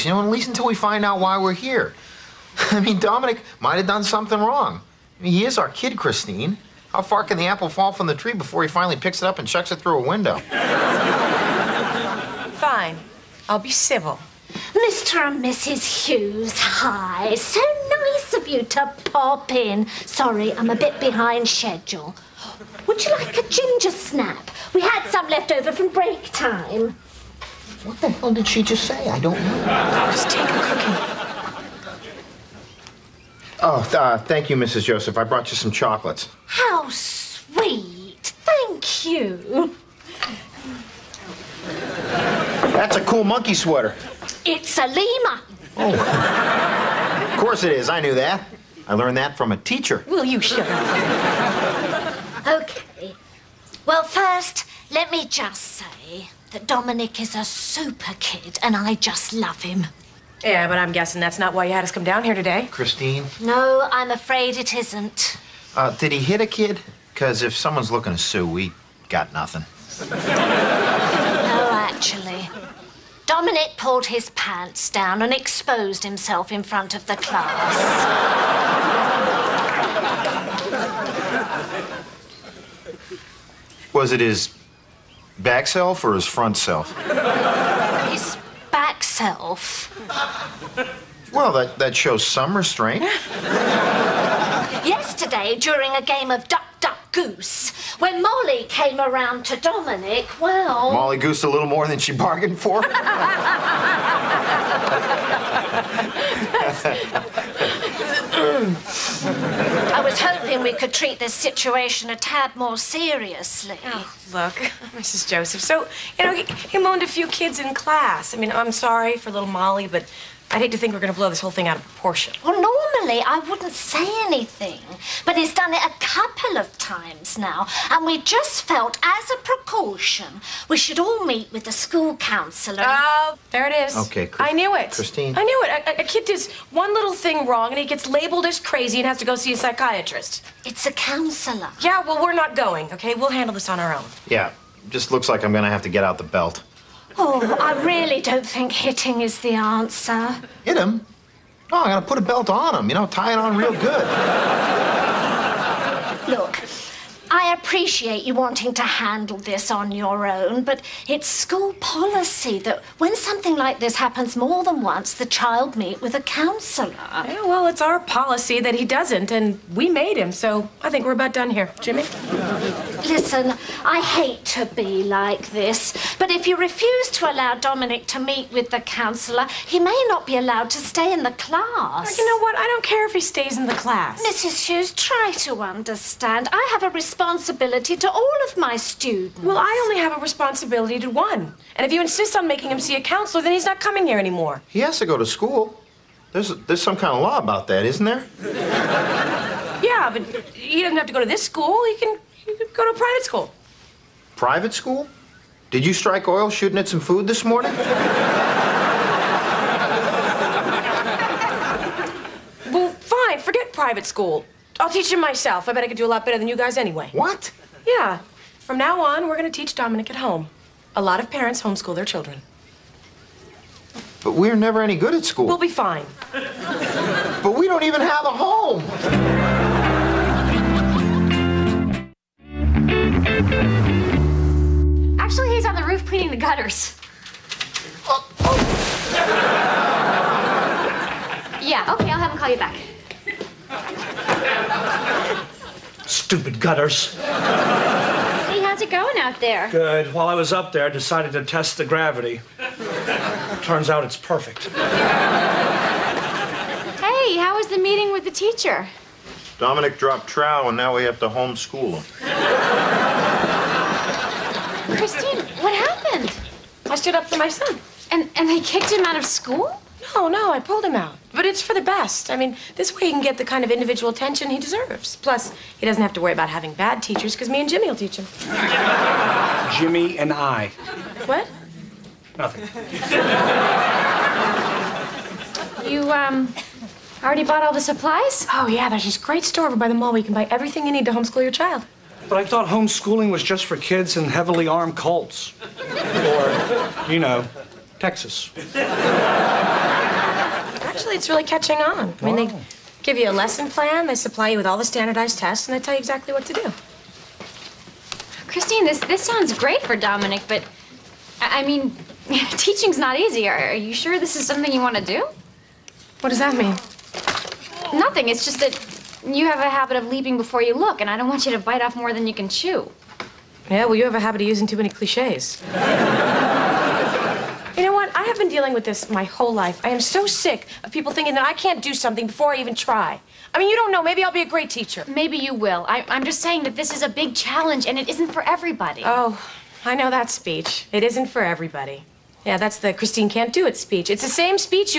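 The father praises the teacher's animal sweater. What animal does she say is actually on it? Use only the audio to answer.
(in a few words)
Lemur.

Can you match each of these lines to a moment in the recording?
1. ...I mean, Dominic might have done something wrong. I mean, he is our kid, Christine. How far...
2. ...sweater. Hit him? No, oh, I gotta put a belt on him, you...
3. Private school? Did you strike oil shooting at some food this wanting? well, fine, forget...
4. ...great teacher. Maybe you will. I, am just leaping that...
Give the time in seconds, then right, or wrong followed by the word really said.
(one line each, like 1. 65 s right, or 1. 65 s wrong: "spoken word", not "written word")
1. 2 s right
2. 149 s wrong: "answer", not "sweater"
3. 204 s wrong: "morning", not "wanting"
4. 334 s wrong: "saying", not "leaping".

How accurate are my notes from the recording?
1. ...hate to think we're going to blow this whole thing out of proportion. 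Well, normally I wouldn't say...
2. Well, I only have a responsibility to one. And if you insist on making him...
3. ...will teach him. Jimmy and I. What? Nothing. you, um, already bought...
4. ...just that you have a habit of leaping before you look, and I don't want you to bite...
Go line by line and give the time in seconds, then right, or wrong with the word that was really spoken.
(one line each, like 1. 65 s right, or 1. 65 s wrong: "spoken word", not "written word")
1. 120 s right
2. 189 s right
3. 277 s right
4. 318 s right.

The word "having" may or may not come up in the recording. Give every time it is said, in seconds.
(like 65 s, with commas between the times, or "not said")
276 s.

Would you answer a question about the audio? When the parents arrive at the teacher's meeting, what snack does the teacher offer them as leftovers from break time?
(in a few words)
Ginger snap.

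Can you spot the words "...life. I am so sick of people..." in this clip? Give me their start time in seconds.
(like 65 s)
329 s.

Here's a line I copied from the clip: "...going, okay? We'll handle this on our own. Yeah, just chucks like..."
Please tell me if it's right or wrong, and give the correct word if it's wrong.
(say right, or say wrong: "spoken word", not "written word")
wrong: "looks", not "chucks".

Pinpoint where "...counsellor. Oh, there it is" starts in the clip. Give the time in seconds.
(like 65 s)
132 s.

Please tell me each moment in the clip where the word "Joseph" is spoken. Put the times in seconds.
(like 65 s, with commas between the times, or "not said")
34 s, 115 s.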